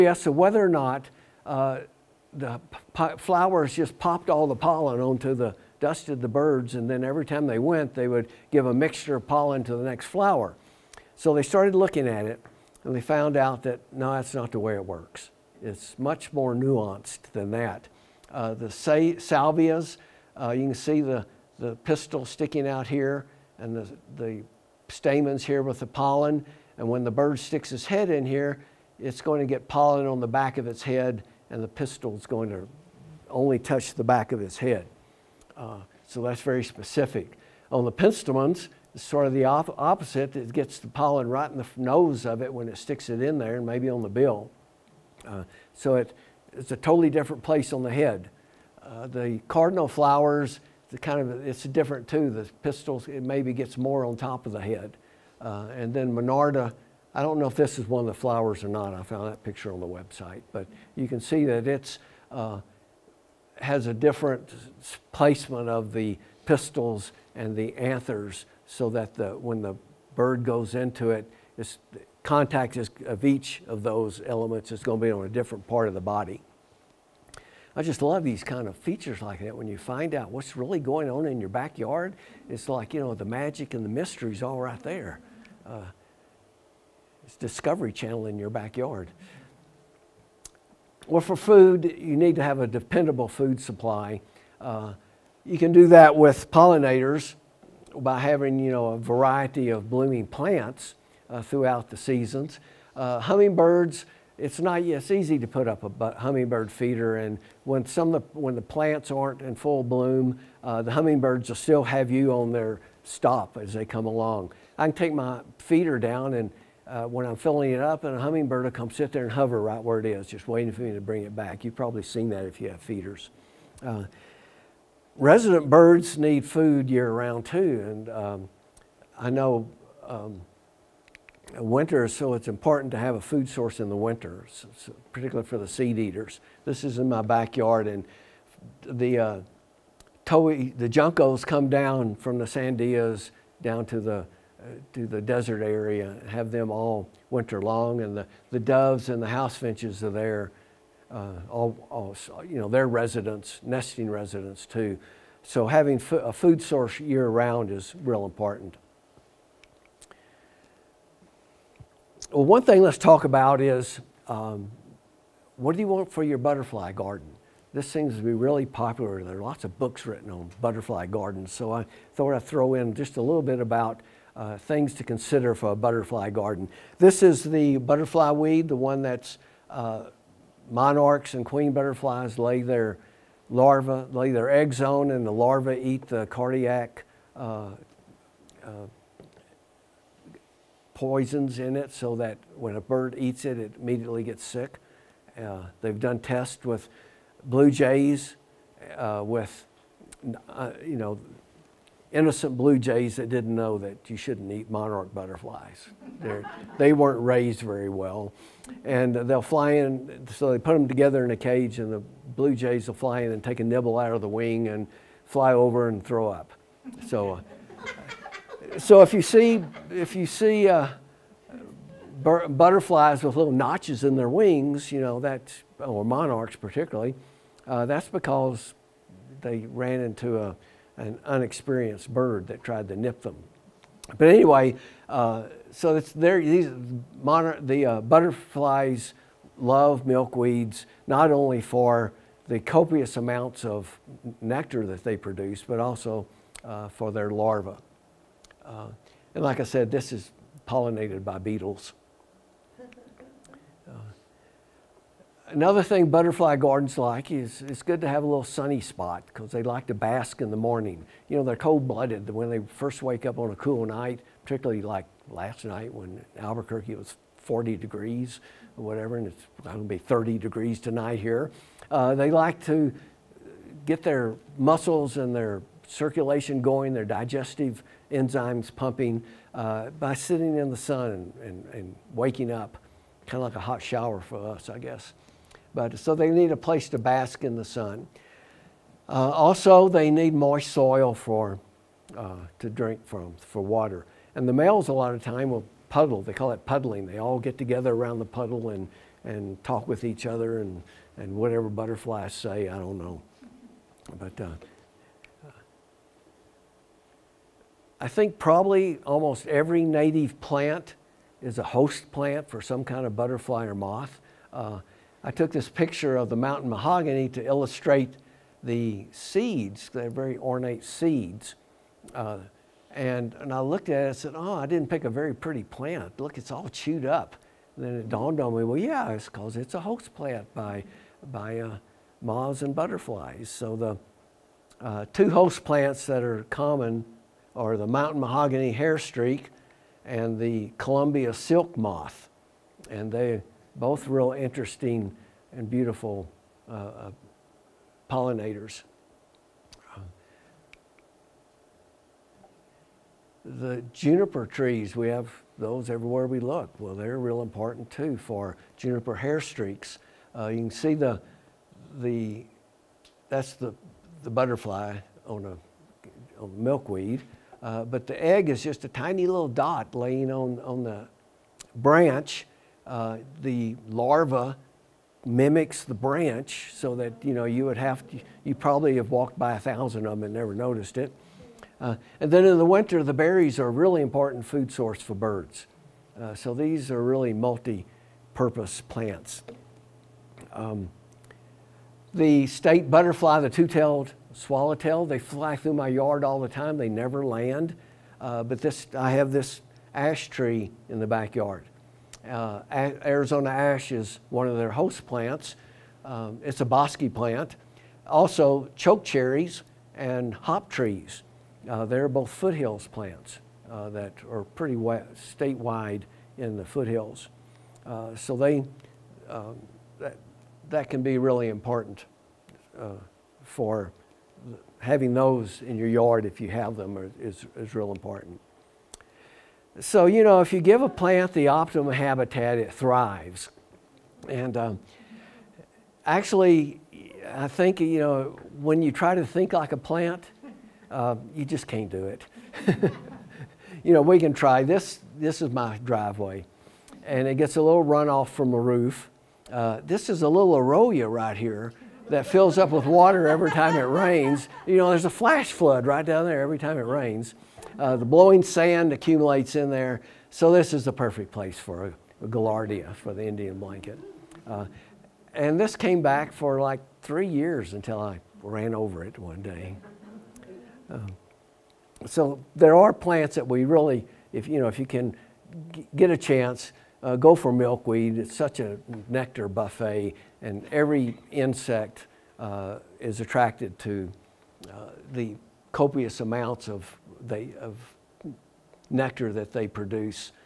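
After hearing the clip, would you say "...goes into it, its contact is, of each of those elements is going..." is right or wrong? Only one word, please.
right.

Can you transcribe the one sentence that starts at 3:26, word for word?
They're, they were not raised very well.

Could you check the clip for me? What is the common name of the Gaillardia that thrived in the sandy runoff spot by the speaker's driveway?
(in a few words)
Indian blanket.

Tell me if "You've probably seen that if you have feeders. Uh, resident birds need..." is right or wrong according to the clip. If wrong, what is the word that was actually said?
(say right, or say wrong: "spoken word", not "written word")
right.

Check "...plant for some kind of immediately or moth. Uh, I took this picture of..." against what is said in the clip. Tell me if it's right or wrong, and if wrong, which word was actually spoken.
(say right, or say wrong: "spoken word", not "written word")
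wrong: "butterfly", not "immediately".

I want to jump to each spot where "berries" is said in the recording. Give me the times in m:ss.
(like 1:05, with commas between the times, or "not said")
6:23.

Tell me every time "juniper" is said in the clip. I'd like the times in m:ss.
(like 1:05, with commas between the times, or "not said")
5:53, 5:58.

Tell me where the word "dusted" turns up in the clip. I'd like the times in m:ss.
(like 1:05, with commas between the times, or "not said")
0:05.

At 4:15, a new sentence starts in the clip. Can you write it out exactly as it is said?
Another thing butterfly gardens like is it's good to have a little sunny spot because they like to bask in the morning.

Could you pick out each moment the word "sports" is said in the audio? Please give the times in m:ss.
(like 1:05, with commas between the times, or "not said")
not said.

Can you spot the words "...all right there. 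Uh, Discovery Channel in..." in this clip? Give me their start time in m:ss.
1:24.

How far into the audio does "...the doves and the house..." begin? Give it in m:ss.
2:28.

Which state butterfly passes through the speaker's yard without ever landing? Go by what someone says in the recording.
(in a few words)
Two-tailed swallowtail.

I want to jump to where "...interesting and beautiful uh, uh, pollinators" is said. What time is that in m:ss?
5:44.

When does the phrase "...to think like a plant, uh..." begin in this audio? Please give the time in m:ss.
7:19.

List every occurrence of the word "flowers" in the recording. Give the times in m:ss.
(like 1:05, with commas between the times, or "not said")
0:03, 0:10, 0:49, 0:58.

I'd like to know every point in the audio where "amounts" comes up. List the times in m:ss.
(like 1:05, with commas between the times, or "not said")
4:03, 8:06.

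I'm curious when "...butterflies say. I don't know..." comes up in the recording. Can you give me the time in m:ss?
5:01.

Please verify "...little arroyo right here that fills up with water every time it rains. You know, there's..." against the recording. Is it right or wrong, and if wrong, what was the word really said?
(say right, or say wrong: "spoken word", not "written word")
right.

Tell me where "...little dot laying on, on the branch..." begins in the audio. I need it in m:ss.
6:09.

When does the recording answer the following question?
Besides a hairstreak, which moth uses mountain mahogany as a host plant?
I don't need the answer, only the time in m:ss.
5:40.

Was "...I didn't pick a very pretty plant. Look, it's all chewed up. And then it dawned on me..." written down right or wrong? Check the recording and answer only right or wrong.
right.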